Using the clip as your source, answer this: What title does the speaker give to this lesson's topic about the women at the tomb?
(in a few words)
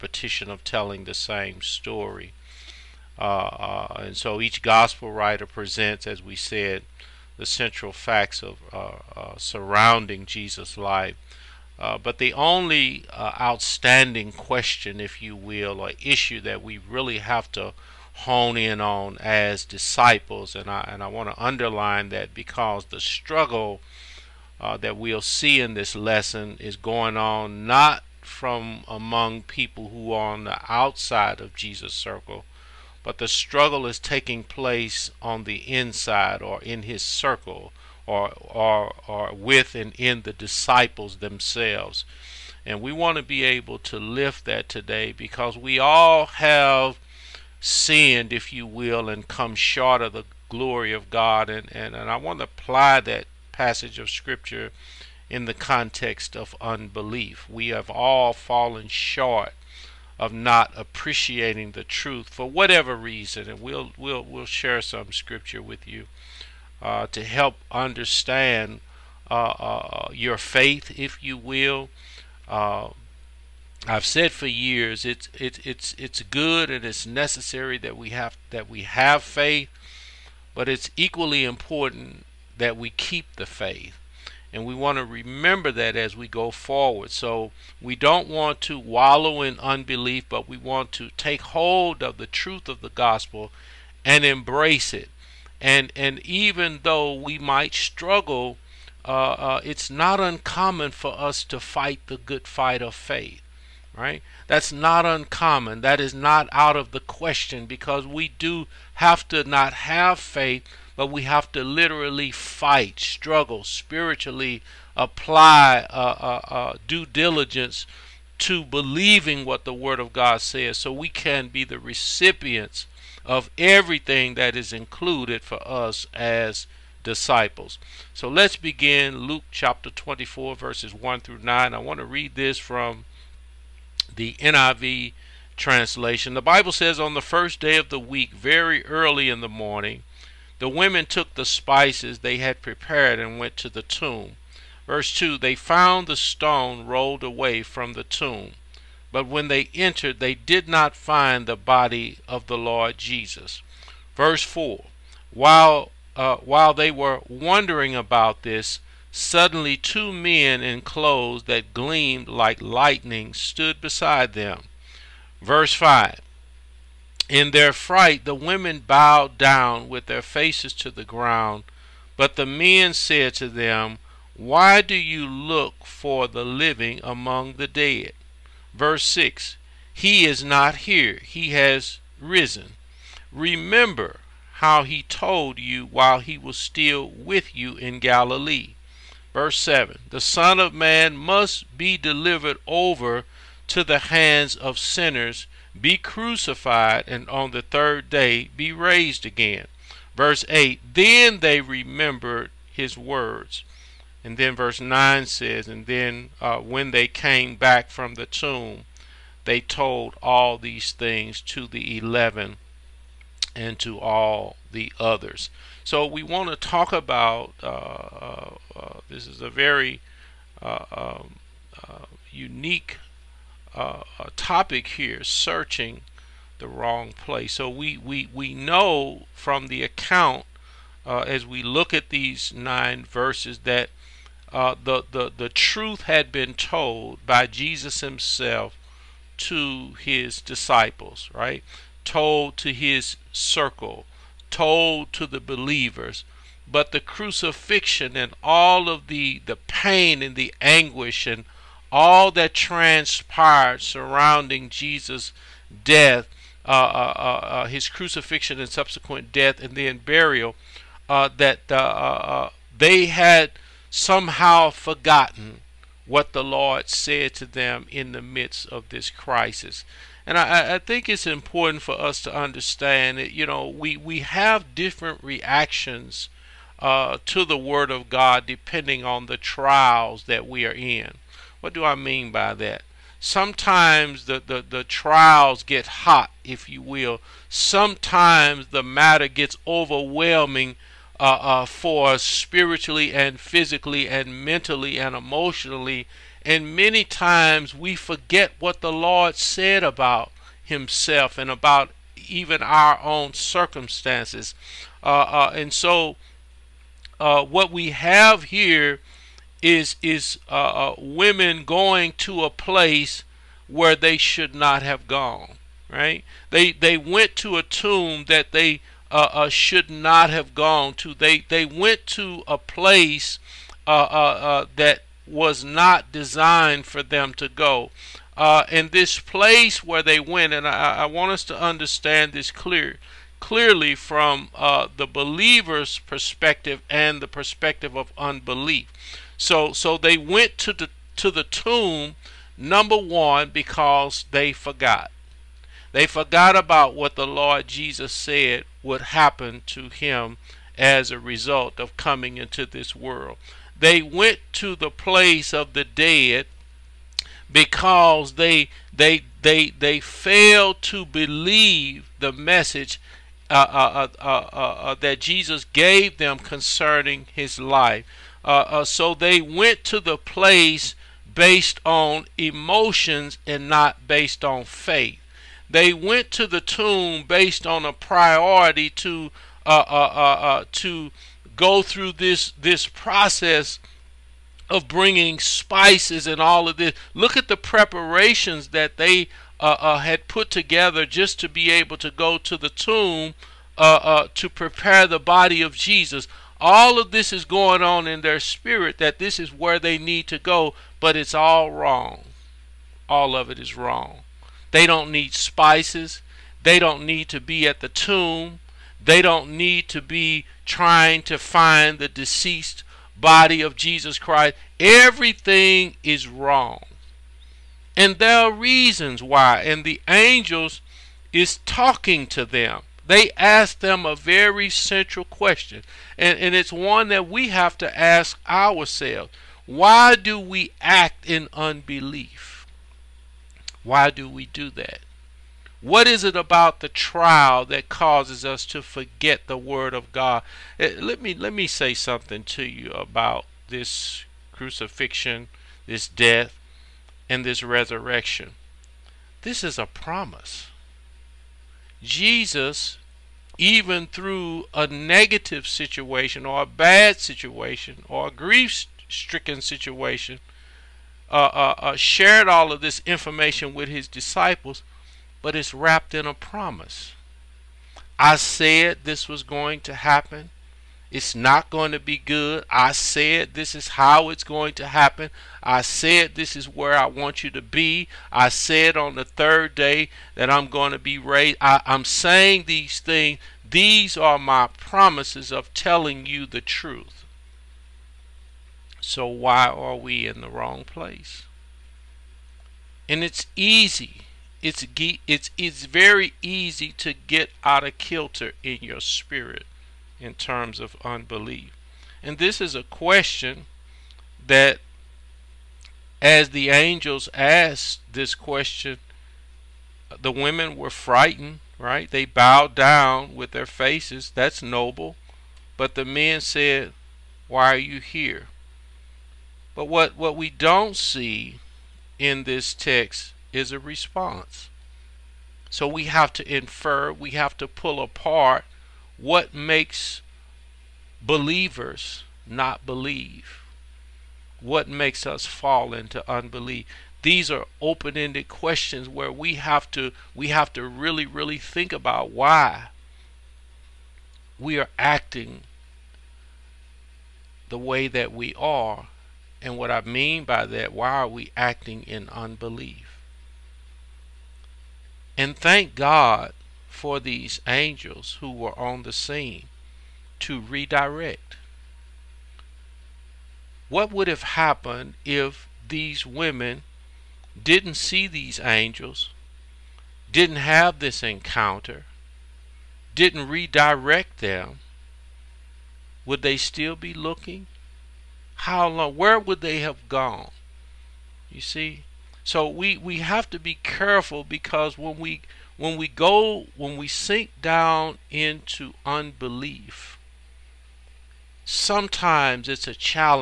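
Searching the wrong place.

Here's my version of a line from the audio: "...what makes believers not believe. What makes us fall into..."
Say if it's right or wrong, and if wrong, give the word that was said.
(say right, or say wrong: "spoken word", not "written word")
right.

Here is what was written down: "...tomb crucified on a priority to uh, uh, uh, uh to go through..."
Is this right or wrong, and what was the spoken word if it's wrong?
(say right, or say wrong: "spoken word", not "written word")
wrong: "based", not "crucified".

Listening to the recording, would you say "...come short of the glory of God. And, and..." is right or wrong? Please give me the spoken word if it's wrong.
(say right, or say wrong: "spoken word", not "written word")
right.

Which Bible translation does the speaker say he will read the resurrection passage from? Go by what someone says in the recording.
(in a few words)
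NIV.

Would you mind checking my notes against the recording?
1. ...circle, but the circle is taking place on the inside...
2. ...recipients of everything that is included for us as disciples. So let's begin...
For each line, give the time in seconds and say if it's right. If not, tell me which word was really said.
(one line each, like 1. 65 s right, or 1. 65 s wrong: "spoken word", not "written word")
1. 31 s wrong: "struggle", not "circle"
2. 121 s right.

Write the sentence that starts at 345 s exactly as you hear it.
They forgot about what the Lord Jesus said would happen to him as a result of coming into this world.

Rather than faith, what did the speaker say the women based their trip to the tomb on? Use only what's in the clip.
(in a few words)
Emotions.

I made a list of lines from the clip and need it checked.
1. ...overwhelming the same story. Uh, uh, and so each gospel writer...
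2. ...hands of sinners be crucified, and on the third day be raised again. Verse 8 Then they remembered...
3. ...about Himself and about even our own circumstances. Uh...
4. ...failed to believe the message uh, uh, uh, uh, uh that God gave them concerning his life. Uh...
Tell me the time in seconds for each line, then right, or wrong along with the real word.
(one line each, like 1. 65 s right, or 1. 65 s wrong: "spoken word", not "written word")
1. 0 s wrong: "telling", not "overwhelming"
2. 193 s right
3. 299 s right
4. 359 s wrong: "Jesus", not "God".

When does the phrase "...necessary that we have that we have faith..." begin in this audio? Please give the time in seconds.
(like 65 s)
77 s.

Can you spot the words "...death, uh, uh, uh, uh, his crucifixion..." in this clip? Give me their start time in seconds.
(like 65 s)
255 s.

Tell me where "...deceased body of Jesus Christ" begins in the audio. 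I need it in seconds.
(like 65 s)
412 s.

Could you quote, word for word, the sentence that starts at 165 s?
Verse 5 in their fright, the women bowed down with their faces to the ground.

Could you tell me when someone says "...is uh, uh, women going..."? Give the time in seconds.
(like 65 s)
310 s.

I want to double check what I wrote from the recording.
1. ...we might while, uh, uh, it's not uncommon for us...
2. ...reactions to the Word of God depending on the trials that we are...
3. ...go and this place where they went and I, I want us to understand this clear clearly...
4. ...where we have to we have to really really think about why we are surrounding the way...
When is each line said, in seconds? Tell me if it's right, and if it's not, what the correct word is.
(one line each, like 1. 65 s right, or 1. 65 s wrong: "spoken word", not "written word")
1. 97 s wrong: "struggle", not "while"
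2. 275 s right
3. 327 s right
4. 539 s wrong: "acting", not "surrounding".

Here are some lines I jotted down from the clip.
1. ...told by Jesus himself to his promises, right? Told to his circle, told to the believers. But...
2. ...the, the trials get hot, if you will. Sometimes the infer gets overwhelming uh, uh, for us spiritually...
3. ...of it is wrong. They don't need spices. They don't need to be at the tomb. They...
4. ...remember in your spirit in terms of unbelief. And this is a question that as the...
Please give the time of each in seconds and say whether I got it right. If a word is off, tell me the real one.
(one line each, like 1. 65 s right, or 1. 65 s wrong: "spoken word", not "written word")
1. 236 s wrong: "disciples", not "promises"
2. 284 s wrong: "matter", not "infer"
3. 403 s right
4. 497 s wrong: "kilter", not "remember".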